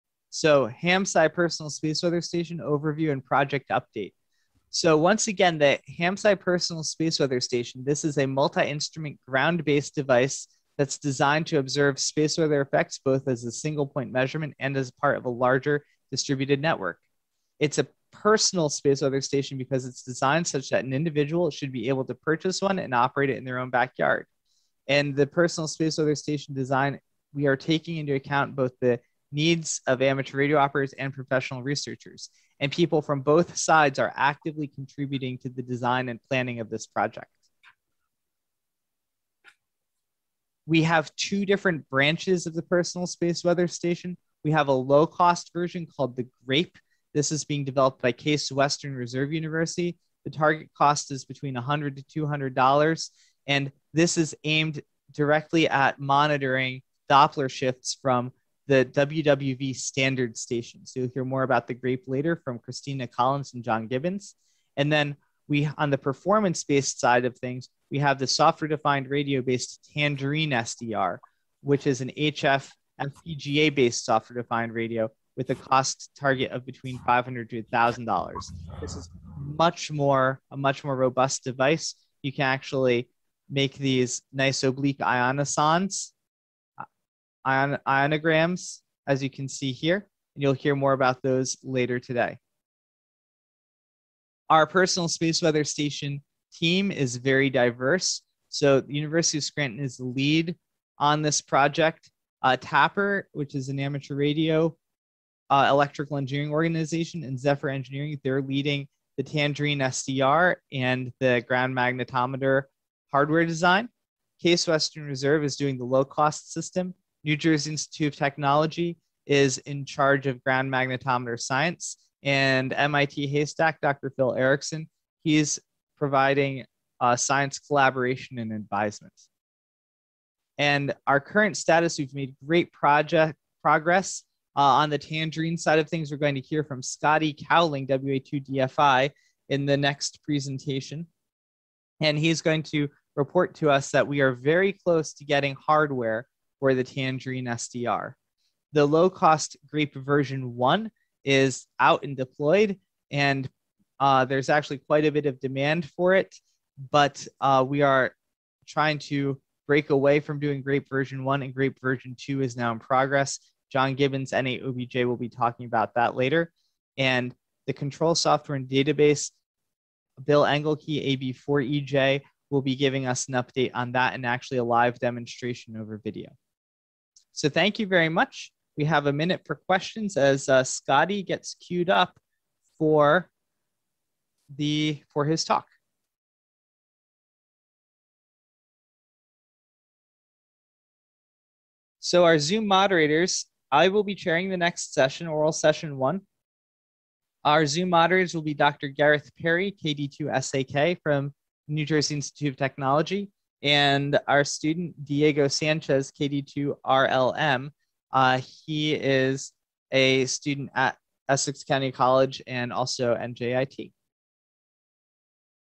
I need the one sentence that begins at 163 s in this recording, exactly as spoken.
John Gibbons, N8OBJ, will be talking about that later.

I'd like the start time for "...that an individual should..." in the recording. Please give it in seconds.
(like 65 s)
20 s.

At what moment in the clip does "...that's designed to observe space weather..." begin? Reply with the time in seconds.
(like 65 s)
10 s.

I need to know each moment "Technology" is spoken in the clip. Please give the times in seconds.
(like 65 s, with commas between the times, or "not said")
118 s, 202 s.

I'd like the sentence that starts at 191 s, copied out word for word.
So our Zoom moderators, I will be chairing the next session, oral session one.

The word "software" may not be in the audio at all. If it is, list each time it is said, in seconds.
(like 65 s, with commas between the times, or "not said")
68 s, 74 s, 168 s.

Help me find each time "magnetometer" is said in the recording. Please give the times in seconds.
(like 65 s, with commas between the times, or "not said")
111 s, 120 s.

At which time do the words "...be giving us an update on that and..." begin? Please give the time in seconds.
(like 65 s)
172 s.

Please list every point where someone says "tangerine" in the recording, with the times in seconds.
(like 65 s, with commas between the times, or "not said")
69 s, 109 s, 134 s, 146 s.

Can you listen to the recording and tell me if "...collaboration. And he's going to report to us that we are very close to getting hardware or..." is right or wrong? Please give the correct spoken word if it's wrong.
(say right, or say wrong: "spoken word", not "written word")
wrong: "presentation", not "collaboration".